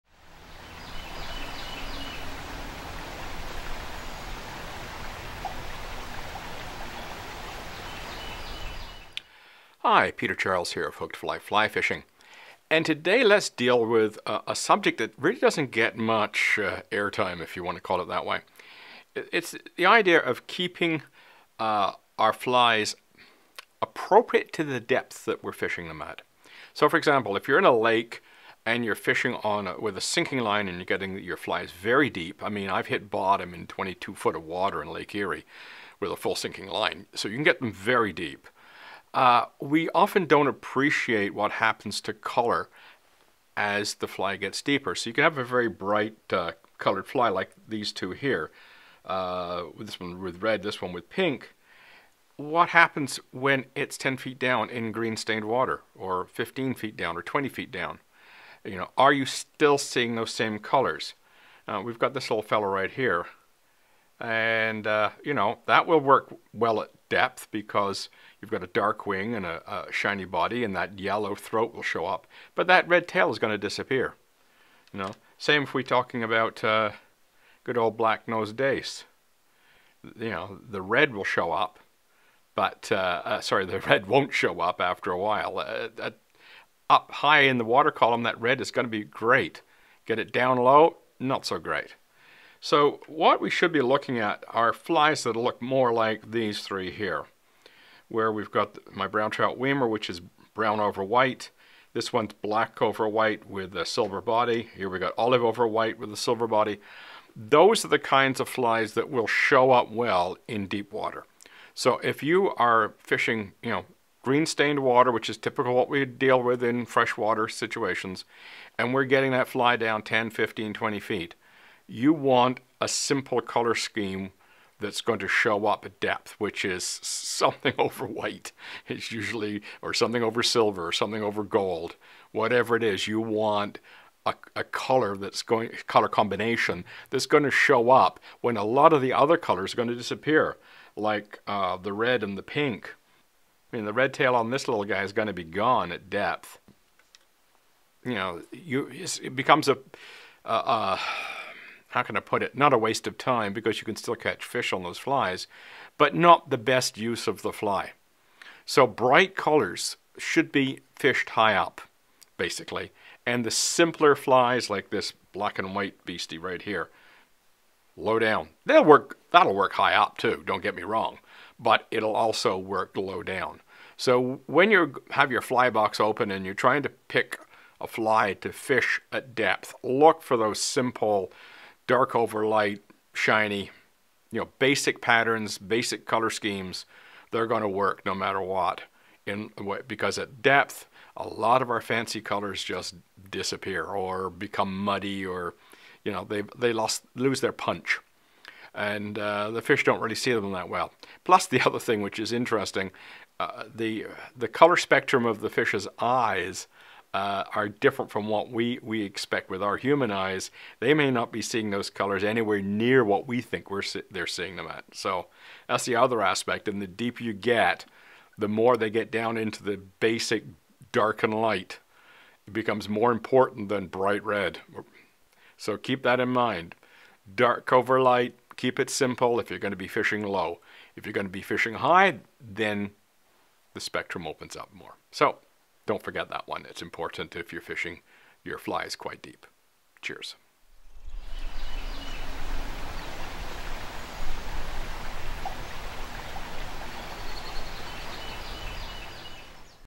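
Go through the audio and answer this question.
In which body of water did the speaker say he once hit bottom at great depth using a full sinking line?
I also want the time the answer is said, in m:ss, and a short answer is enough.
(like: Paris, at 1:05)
Lake Erie, at 0:34.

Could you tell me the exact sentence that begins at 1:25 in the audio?
Uh, uh, up high in the water column, that red is going to be great.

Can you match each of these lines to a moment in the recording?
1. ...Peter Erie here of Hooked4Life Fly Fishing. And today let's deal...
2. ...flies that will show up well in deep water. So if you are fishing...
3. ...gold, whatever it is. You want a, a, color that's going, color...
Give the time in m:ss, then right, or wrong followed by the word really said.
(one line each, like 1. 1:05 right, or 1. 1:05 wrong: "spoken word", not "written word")
1. 0:10 wrong: "Charles", not "Erie"
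2. 1:48 right
3. 2:11 right.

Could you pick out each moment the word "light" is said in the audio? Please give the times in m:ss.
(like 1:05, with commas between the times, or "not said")
3:02, 3:41, 3:48.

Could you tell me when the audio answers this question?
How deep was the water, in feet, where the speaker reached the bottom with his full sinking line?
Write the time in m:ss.
0:33.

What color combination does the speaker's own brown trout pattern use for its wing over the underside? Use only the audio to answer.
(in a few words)
brown over white.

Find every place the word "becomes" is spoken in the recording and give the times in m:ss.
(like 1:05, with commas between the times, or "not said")
2:29, 3:14, 3:42.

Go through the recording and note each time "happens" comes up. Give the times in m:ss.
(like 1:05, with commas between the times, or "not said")
0:41, 0:52.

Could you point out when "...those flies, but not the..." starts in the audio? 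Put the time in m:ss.
2:34.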